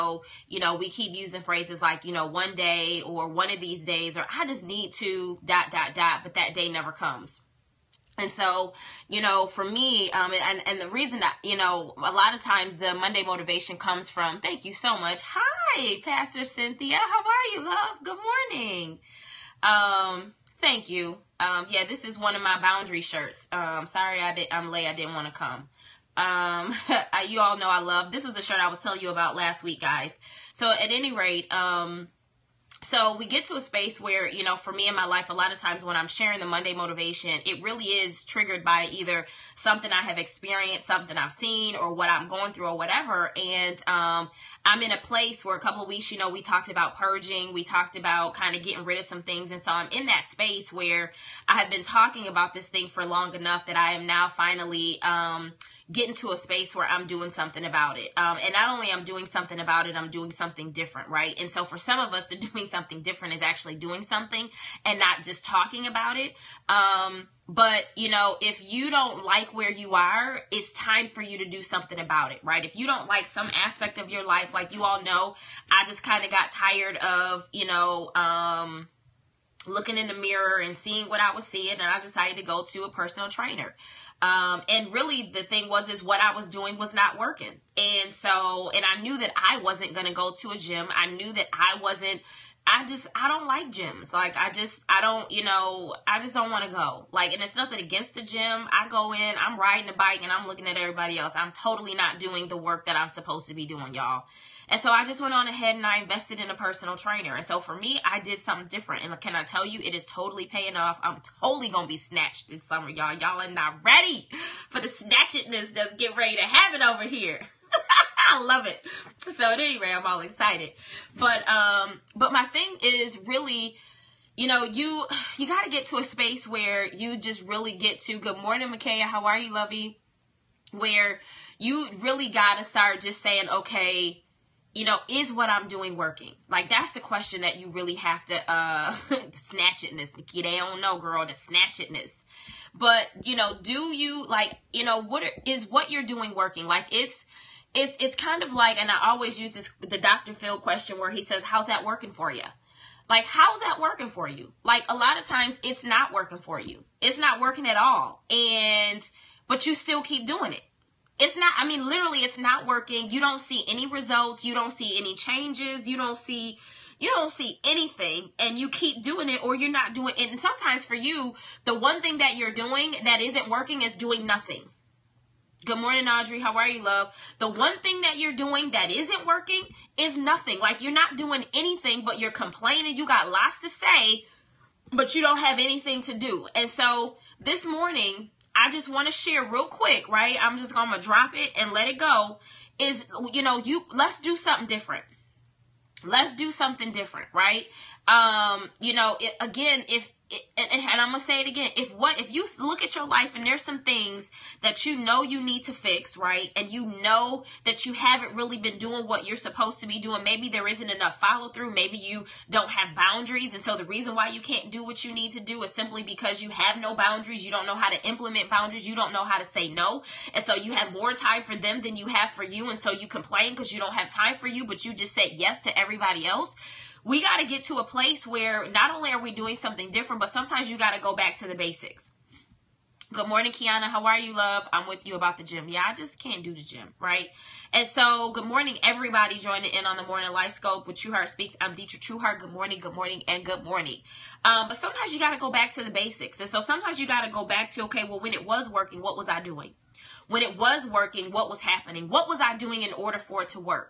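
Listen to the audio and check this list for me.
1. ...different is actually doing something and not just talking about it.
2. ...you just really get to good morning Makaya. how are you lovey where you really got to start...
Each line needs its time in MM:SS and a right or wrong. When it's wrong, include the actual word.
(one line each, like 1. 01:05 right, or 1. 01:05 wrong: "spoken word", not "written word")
1. 01:03 right
2. 02:06 right.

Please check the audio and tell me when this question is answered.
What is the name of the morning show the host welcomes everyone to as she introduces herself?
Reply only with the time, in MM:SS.
04:00.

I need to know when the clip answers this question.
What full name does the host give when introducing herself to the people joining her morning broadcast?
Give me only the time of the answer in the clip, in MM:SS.
04:01.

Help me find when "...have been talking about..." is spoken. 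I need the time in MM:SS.
00:51.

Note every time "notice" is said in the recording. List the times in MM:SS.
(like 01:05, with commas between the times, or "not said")
not said.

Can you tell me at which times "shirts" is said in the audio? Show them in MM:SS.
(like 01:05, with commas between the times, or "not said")
00:23, 00:28.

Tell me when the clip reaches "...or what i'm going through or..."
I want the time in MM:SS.
00:41.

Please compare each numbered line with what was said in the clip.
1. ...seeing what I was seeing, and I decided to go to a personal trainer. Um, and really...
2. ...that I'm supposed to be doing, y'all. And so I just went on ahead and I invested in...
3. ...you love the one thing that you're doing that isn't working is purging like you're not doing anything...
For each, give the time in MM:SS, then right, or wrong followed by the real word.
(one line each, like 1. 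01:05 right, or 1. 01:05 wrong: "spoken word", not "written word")
1. 01:20 right
2. 01:42 right
3. 02:56 wrong: "nothing", not "purging".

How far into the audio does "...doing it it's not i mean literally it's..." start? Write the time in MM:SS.
02:40.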